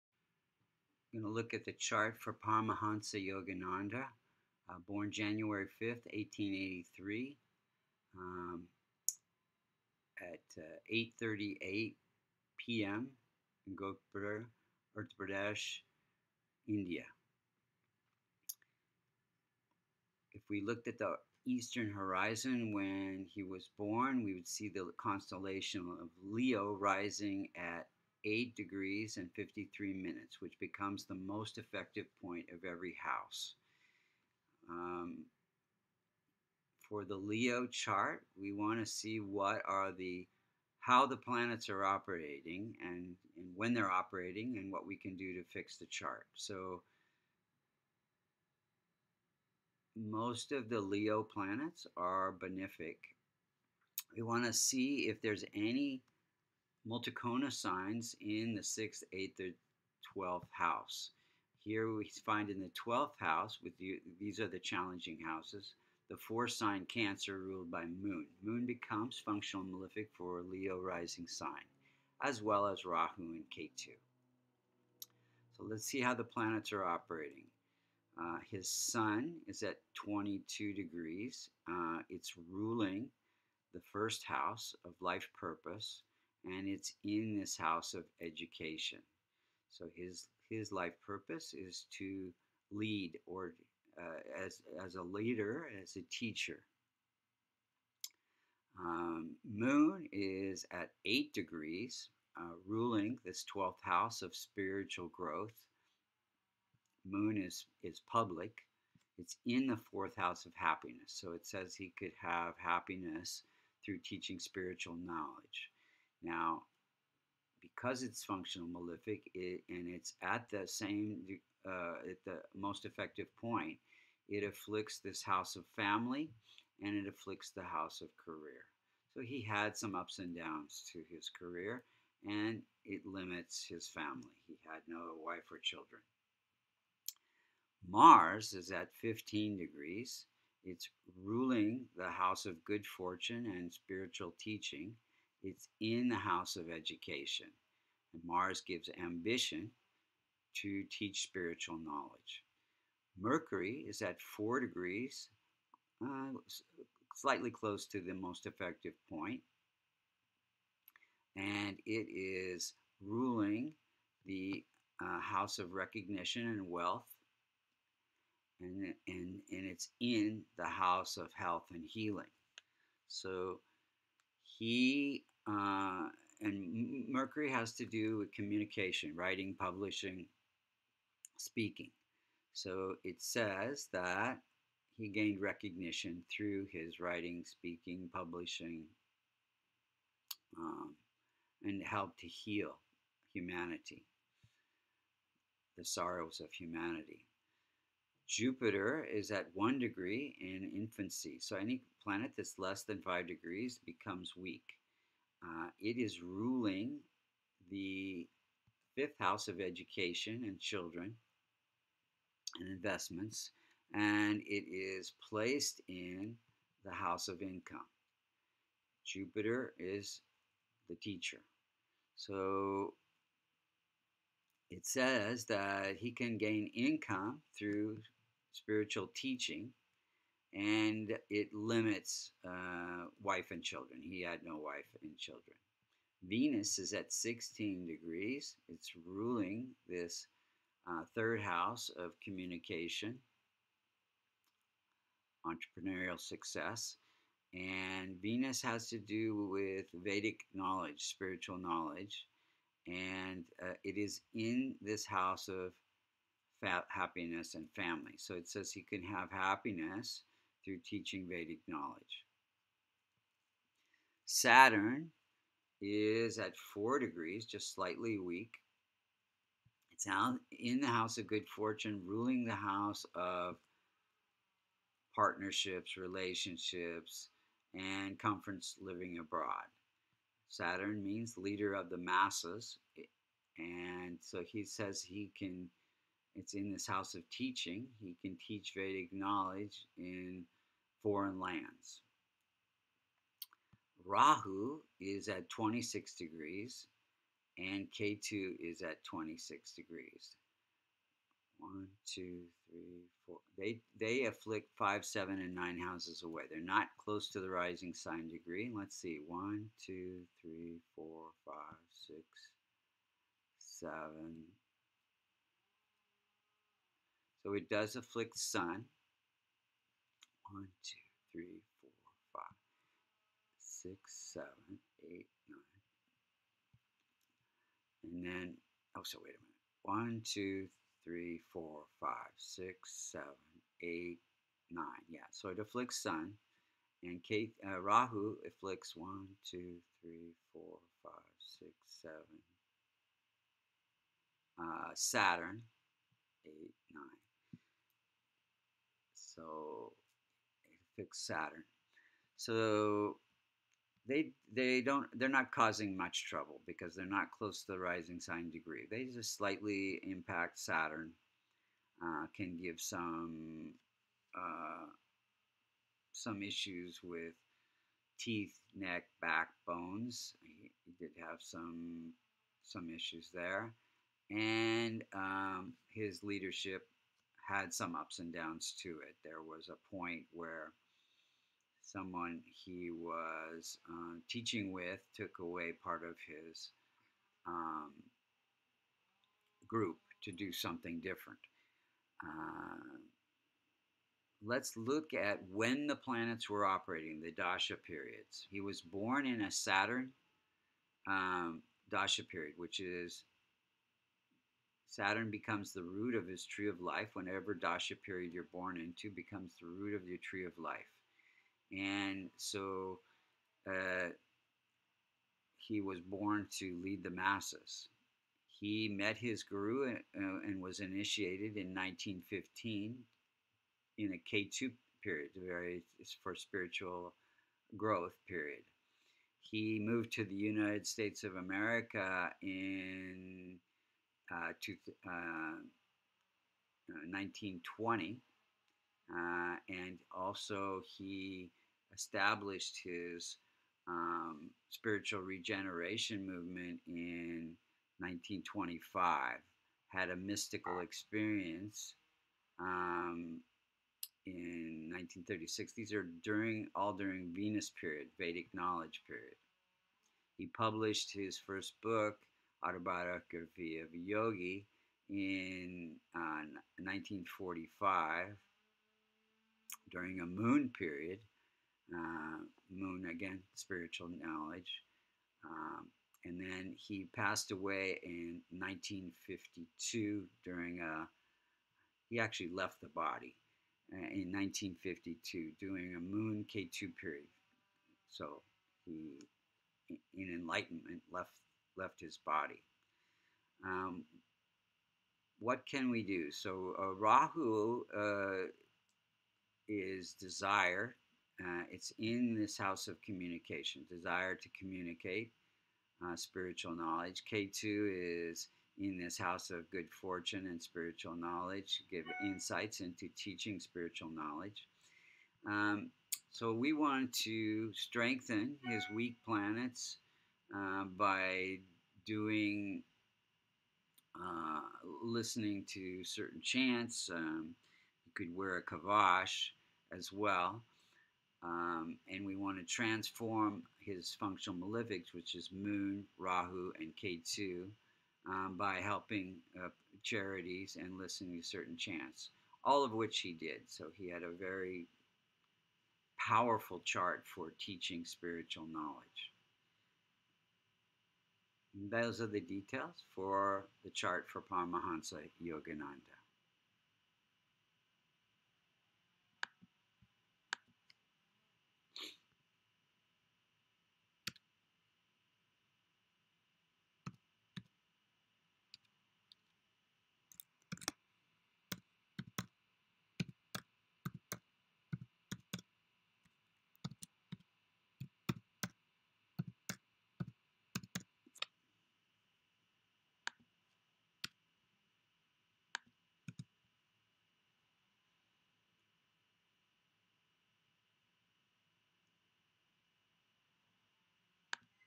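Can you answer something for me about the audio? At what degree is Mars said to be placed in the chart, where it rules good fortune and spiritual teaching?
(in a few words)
15 degrees.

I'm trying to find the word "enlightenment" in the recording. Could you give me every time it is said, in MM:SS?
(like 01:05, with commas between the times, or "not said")
08:10.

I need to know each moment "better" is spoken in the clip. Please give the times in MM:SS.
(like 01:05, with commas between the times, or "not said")
not said.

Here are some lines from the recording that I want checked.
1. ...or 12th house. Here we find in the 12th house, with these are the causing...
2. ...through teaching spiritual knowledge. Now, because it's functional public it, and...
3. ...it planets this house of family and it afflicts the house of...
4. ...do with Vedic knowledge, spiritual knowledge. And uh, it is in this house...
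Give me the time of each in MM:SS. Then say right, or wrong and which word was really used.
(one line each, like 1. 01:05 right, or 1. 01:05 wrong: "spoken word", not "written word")
1. 01:00 wrong: "challenging", not "causing"
2. 01:53 wrong: "malefic", not "public"
3. 02:04 wrong: "afflicts", not "planets"
4. 04:08 right.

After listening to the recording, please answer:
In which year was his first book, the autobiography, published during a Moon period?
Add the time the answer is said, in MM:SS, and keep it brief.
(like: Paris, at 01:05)
1945, at 07:46.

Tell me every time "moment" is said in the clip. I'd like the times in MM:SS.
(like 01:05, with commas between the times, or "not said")
not said.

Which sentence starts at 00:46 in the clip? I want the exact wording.
So most of the Leo planets are benefic.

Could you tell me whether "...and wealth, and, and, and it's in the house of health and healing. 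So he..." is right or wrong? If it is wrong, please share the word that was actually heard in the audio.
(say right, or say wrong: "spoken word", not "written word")
right.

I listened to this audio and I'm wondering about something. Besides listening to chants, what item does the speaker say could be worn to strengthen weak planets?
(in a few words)
kavash.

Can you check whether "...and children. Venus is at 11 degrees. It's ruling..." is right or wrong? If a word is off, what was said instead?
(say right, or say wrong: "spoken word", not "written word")
wrong: "16", not "11".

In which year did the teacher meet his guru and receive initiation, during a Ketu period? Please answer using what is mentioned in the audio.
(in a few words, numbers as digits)
1915.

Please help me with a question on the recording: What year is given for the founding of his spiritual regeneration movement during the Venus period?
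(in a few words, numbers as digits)
1925.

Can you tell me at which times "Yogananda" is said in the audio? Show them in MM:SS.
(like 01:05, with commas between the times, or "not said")
00:03, 09:15.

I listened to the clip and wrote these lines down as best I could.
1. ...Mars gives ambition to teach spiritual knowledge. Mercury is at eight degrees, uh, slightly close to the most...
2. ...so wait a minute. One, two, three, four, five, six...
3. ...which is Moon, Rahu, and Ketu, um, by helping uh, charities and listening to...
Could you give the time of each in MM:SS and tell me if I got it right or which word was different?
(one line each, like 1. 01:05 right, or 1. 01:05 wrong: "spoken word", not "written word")
1. 02:28 wrong: "four", not "eight"
2. 05:29 right
3. 08:55 right.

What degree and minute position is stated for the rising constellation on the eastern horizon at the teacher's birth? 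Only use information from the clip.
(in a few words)
8 degrees 53 minutes.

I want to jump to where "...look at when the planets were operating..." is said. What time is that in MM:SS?
06:34.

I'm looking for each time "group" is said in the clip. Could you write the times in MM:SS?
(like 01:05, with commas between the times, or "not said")
06:29.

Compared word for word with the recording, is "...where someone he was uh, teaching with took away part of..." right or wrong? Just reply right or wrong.
right.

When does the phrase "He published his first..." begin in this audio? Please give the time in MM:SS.
07:40.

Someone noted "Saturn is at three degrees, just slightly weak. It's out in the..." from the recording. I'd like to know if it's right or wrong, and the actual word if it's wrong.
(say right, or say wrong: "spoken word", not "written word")
wrong: "four", not "three".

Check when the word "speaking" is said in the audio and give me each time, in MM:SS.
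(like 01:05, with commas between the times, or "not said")
03:01, 03:07.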